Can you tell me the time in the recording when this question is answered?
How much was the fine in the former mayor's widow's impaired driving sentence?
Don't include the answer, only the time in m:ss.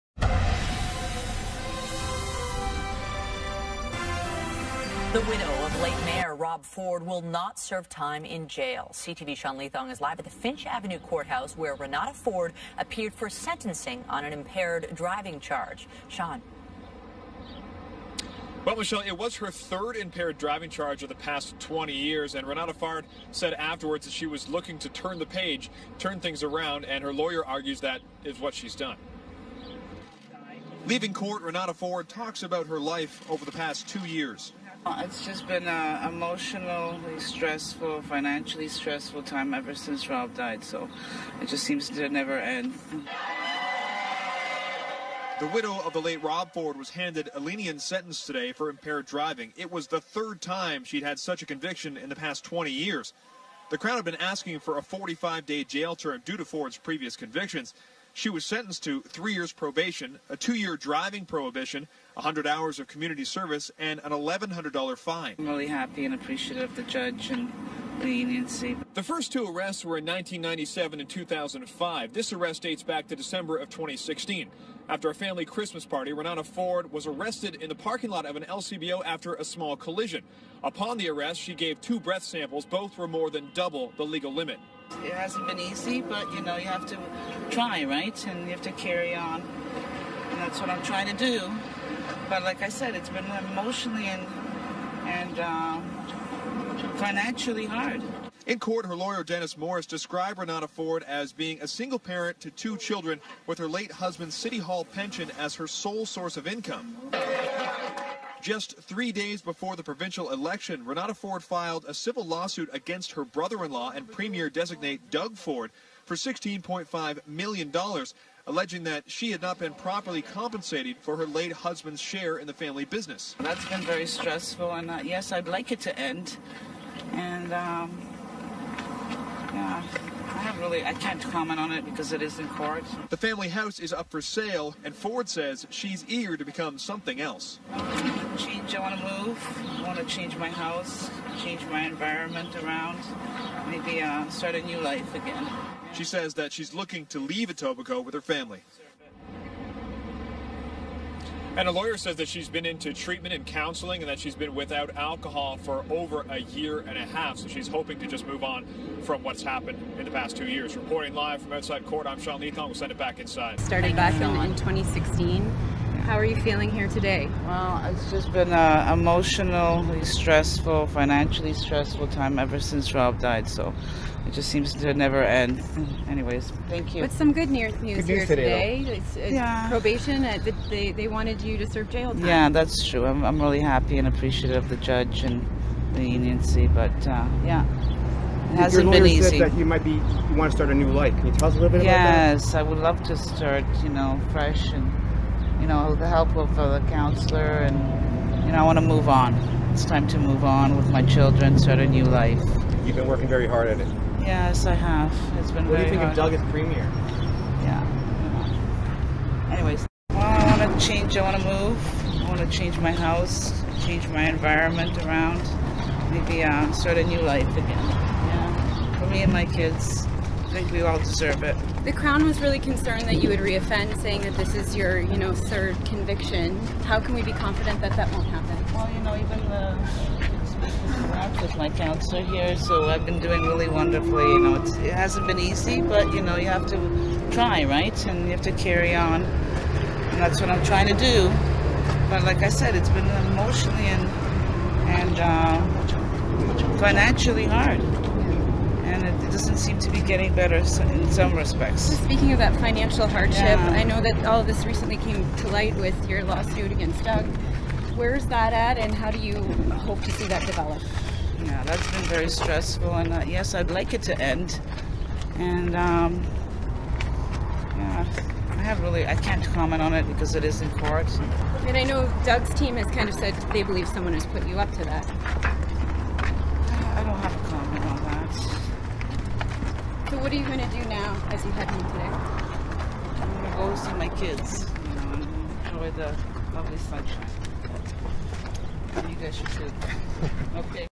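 1:04.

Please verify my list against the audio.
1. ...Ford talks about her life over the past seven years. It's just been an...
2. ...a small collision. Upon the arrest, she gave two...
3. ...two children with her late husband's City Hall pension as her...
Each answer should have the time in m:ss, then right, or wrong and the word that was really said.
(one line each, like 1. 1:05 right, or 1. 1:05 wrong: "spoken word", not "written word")
1. 0:31 wrong: "two", not "seven"
2. 1:19 right
3. 1:42 right.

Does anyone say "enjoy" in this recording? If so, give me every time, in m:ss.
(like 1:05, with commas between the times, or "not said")
4:45.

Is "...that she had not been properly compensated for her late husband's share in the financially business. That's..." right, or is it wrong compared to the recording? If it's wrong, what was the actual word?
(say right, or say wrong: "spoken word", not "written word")
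wrong: "family", not "financially".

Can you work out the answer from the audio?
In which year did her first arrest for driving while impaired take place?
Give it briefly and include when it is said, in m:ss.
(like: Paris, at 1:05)
1997, at 1:10.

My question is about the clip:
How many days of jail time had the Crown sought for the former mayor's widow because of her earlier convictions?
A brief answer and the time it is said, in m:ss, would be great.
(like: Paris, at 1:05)
45 days, at 0:54.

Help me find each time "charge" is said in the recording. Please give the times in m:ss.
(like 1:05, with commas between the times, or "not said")
0:15, 0:20.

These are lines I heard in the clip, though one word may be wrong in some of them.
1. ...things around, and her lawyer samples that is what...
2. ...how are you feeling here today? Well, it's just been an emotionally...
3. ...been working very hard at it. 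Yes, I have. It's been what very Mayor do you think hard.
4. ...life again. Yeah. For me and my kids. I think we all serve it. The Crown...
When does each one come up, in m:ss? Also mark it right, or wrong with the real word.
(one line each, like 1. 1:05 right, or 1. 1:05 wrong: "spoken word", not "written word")
1. 0:26 wrong: "argues", not "samples"
2. 2:46 right
3. 3:22 wrong: "What", not "Mayor"
4. 3:37 wrong: "deserve", not "serve".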